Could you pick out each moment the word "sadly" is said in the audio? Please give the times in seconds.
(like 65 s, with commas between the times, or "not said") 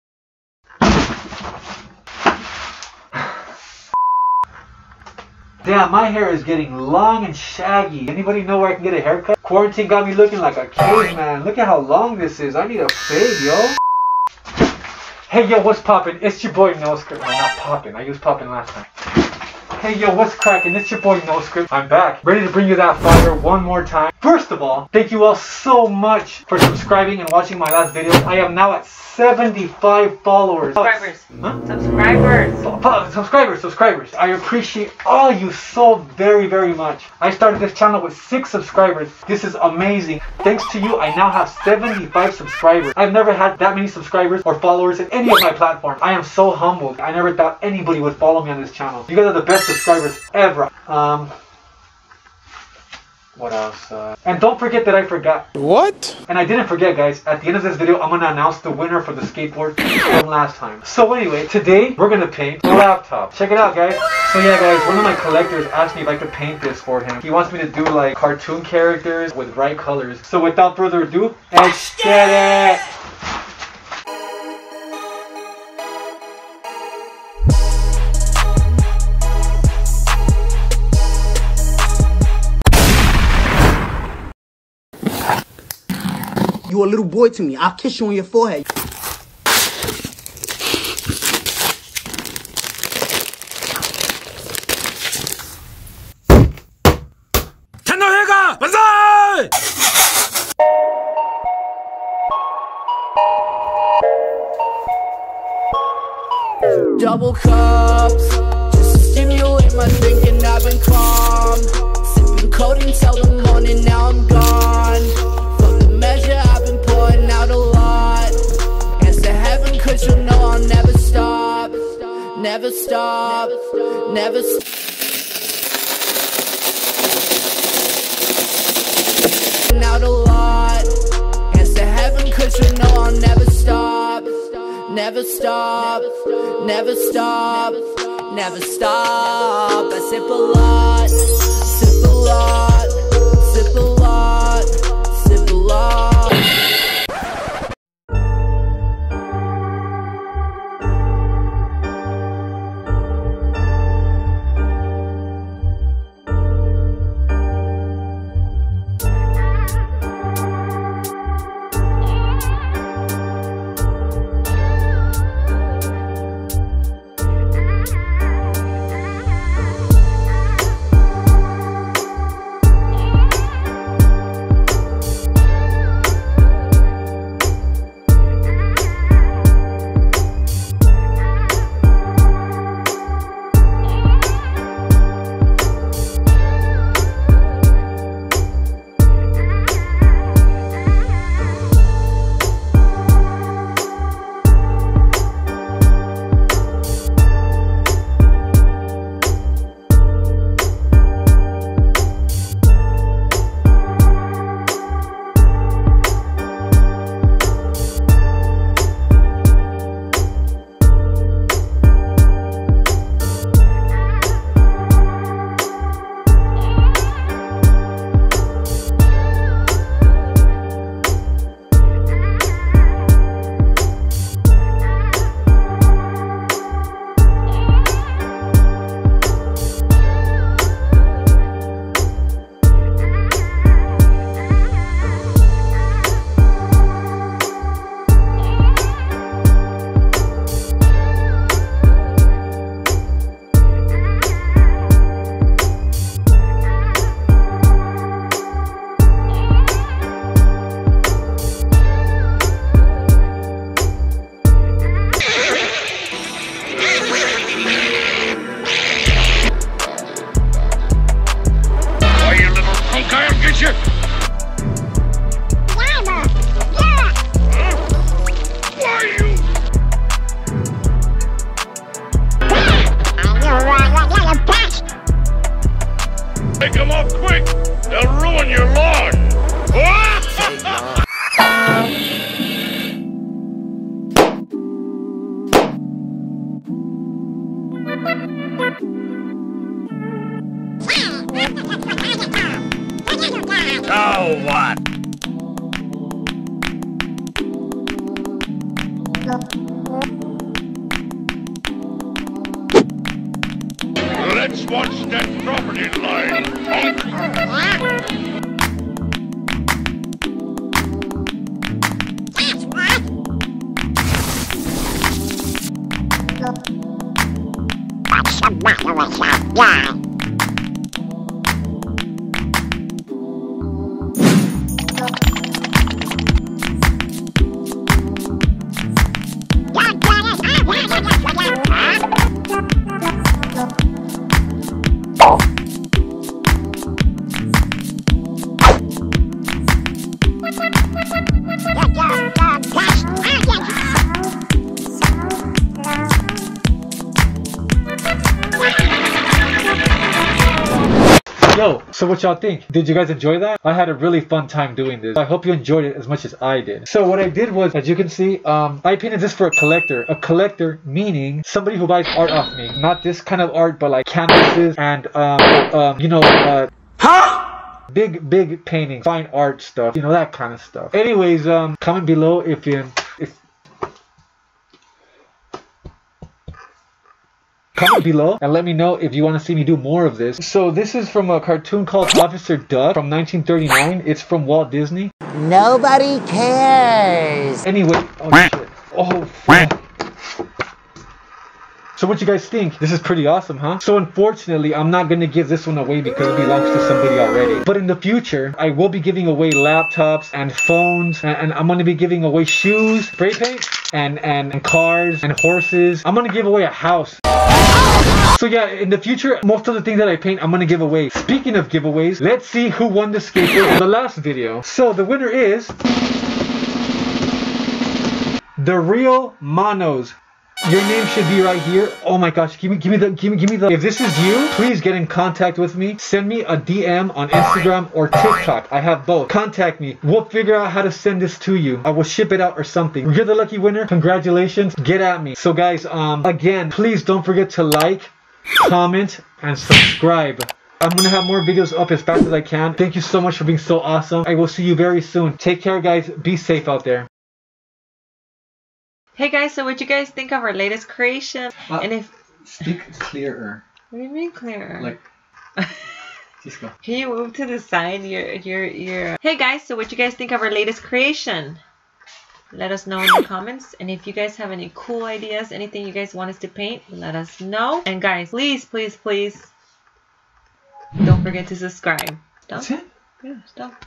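not said.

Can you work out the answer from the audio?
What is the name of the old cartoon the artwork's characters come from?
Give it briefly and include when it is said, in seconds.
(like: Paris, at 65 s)
Officer Duck, at 382 s.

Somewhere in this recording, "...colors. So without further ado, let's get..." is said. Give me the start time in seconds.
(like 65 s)
69 s.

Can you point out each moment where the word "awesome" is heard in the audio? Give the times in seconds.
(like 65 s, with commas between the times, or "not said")
393 s, 443 s.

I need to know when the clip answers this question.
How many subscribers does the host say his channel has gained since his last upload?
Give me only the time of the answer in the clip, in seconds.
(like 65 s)
28 s.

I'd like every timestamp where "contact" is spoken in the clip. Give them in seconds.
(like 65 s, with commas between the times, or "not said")
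425 s, 429 s.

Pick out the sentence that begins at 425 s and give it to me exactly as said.
Send me a DM on Instagram or TikTok.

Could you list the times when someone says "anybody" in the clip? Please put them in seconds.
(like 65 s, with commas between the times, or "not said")
8 s, 47 s.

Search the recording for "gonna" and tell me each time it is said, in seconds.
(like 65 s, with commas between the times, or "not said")
410 s, 440 s.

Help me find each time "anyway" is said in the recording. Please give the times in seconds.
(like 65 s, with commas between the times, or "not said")
61 s, 370 s, 387 s.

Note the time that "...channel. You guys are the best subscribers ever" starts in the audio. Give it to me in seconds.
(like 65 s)
48 s.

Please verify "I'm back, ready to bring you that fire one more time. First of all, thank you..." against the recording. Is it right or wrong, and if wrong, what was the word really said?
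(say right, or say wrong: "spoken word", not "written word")
right.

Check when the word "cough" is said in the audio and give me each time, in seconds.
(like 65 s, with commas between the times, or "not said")
not said.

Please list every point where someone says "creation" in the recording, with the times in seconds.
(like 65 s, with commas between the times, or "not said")
450 s, 460 s.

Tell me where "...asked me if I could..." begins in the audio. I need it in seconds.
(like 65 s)
65 s.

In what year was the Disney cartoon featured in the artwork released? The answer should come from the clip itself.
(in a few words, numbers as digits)
1939.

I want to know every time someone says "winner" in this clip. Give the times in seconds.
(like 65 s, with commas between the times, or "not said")
58 s, 415 s, 433 s.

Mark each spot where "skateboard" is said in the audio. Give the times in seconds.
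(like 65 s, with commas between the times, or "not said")
59 s, 413 s.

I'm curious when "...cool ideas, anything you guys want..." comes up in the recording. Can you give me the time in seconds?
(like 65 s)
464 s.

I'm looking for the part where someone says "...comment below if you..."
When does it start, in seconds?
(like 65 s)
371 s.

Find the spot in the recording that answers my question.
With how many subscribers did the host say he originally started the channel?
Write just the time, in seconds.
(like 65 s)
38 s.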